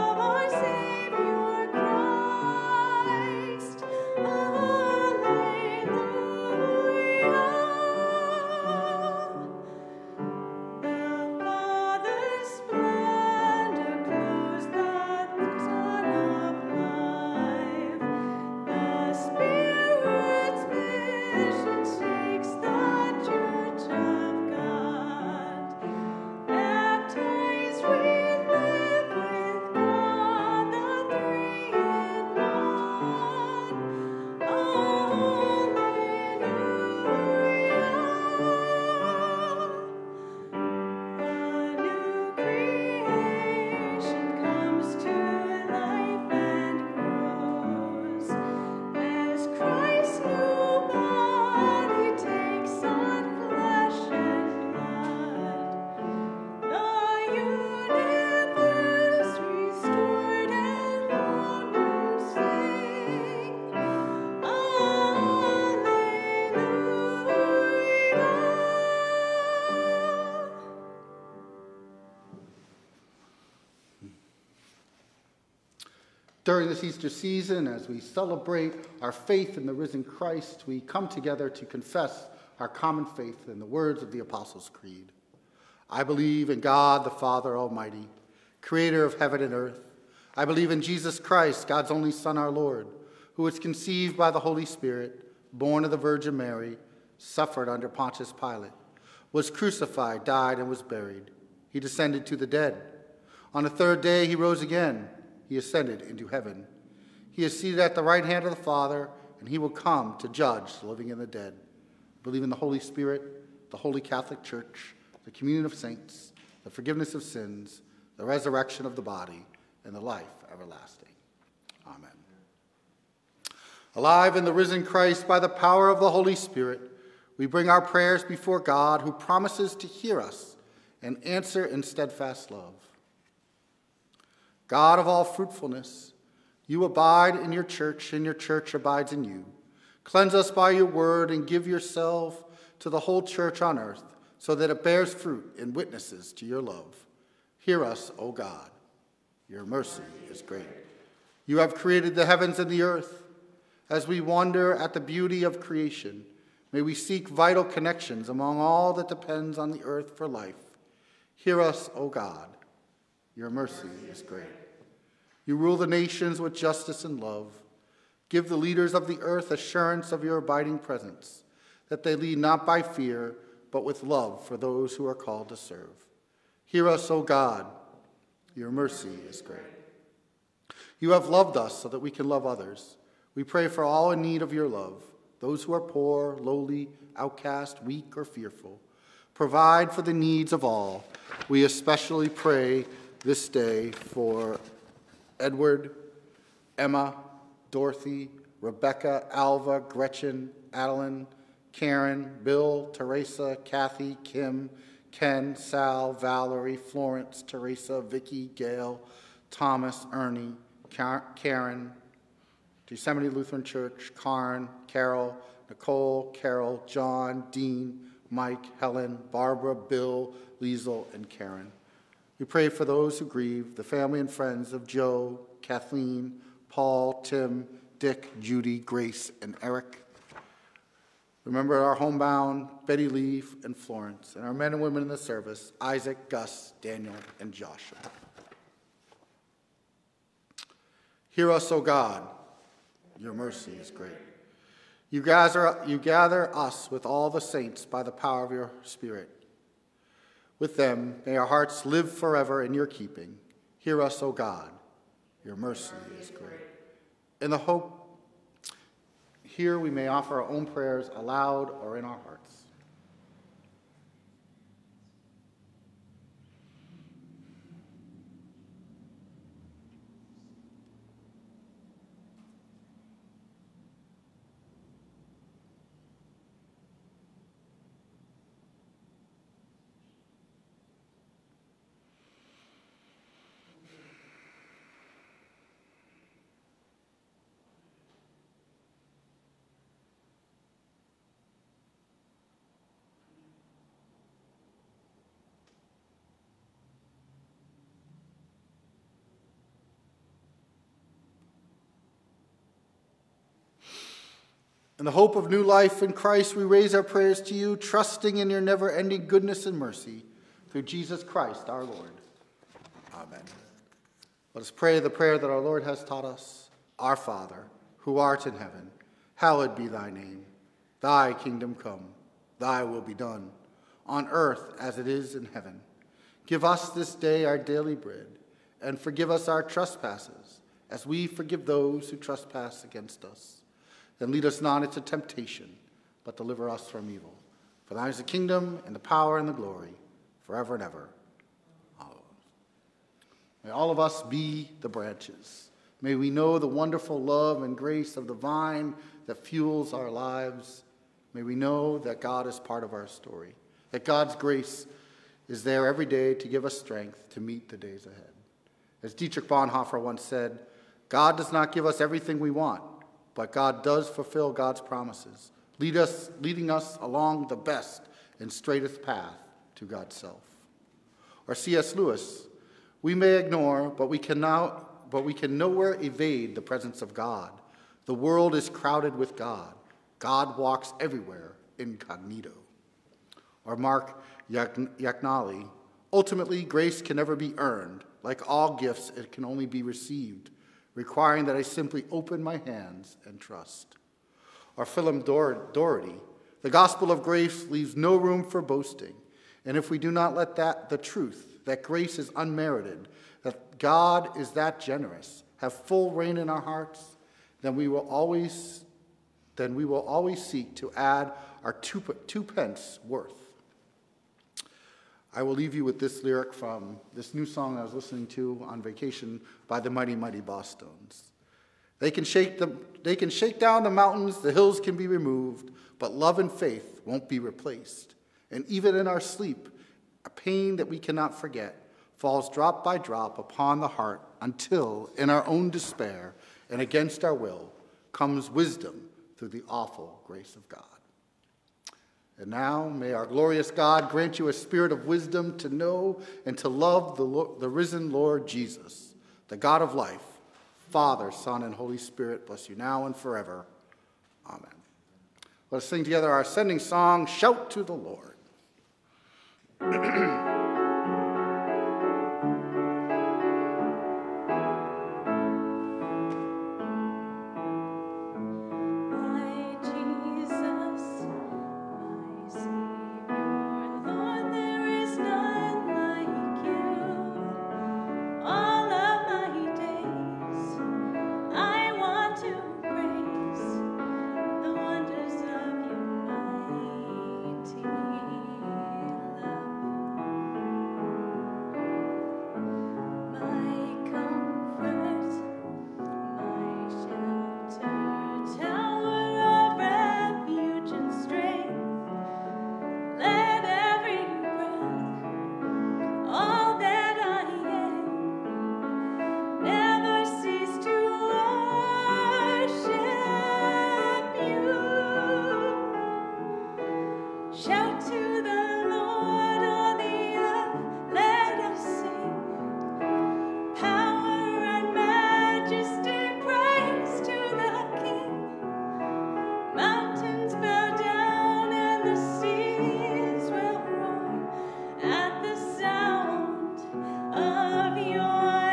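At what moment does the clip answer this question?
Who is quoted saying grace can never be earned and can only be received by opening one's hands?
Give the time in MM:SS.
06:23.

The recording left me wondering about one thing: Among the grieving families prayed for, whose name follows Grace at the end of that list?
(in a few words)
Eric.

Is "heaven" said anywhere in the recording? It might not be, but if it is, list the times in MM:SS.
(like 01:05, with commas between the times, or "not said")
01:29, 01:46, 02:32, 05:18, 05:25.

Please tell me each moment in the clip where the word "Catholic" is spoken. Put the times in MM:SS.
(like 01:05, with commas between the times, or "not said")
01:53.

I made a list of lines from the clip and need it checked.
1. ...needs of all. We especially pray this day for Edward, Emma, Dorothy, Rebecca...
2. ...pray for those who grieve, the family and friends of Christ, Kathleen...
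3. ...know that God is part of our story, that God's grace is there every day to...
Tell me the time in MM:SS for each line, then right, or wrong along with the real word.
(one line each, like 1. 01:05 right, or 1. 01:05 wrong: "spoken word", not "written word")
1. 03:10 right
2. 03:42 wrong: "Joe", not "Christ"
3. 05:51 right.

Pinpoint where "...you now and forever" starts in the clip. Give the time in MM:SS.
07:32.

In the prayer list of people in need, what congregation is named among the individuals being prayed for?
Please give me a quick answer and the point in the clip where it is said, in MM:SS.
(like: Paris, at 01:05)
Yosemite Lutheran Church, at 03:32.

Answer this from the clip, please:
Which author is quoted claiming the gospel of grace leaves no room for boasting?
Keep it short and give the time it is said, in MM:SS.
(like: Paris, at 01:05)
Philip Doherty, at 06:34.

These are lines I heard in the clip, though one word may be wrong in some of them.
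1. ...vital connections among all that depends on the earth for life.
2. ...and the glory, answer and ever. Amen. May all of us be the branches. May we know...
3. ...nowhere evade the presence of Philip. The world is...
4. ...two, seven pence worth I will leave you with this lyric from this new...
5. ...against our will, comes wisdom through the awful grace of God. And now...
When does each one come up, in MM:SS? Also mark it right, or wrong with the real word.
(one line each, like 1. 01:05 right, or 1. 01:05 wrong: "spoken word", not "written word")
1. 02:37 right
2. 05:39 wrong: "forever", not "answer"
3. 06:15 wrong: "God", not "Philip"
4. 06:51 wrong: "two", not "seven"
5. 07:16 right.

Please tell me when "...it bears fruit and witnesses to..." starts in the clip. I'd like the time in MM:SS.
02:24.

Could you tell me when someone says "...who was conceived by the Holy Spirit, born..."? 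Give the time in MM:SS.
01:33.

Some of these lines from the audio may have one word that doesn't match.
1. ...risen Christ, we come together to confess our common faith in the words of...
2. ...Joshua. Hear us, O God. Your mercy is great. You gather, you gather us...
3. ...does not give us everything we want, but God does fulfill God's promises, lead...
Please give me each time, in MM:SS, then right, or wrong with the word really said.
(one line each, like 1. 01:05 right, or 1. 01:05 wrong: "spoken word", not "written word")
1. 01:19 right
2. 03:57 right
3. 06:01 right.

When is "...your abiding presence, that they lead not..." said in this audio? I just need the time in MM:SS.
02:50.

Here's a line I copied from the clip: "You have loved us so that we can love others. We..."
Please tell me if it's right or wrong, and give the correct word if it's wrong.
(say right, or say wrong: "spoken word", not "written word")
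right.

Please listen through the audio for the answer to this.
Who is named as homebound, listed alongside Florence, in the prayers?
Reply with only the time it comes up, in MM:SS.
03:52.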